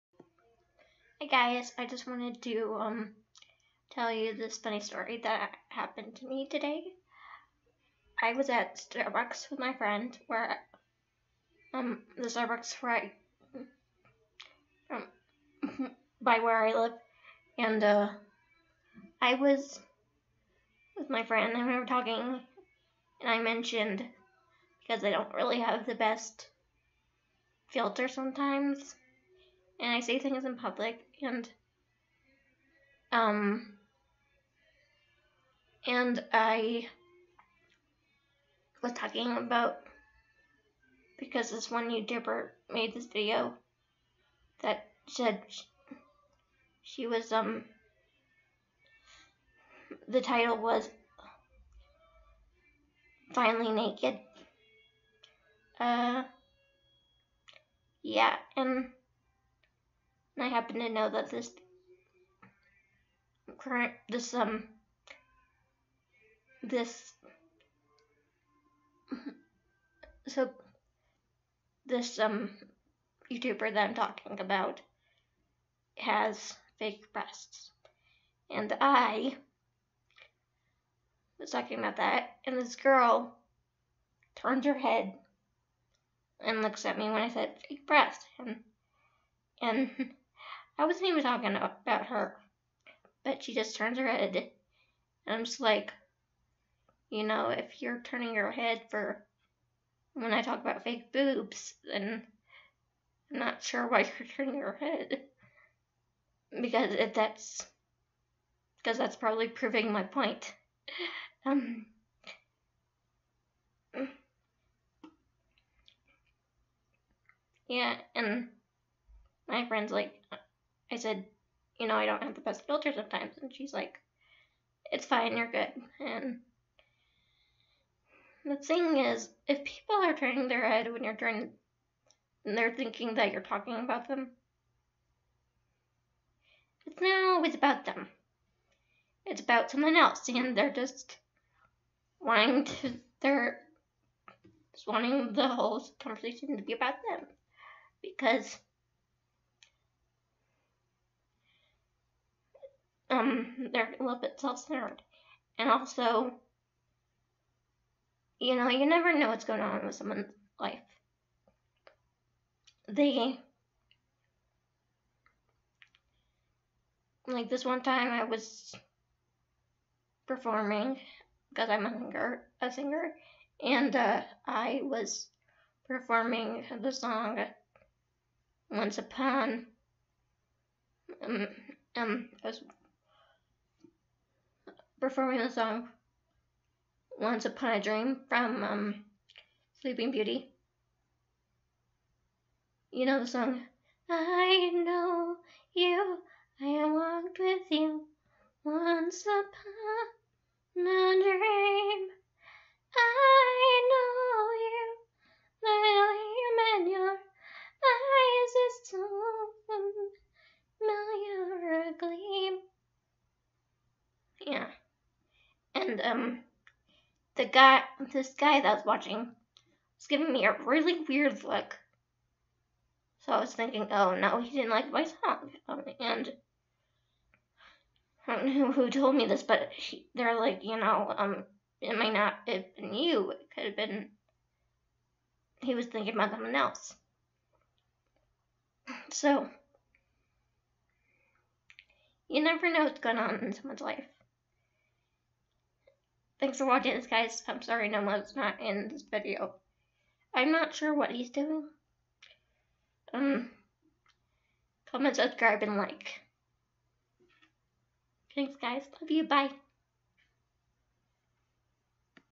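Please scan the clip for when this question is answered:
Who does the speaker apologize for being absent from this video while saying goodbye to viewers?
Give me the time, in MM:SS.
04:07.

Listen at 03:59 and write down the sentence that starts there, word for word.
So, you never know what's going on in someone's life.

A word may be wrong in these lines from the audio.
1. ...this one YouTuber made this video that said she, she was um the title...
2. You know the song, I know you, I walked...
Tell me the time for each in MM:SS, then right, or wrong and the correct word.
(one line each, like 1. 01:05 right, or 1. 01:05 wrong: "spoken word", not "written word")
1. 00:41 right
2. 03:12 right.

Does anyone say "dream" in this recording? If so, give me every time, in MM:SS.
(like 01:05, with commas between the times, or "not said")
03:07, 03:21.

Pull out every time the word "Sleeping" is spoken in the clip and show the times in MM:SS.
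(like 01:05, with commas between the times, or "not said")
03:09.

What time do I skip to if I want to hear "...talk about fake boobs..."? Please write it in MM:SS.
01:40.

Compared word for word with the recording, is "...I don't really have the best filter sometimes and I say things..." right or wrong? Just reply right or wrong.
right.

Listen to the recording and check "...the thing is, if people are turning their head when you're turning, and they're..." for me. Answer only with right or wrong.
right.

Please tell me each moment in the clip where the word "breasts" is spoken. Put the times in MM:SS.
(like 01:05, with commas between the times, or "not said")
01:17, 01:27.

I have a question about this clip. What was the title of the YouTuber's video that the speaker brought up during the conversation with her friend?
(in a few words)
Finally Naked.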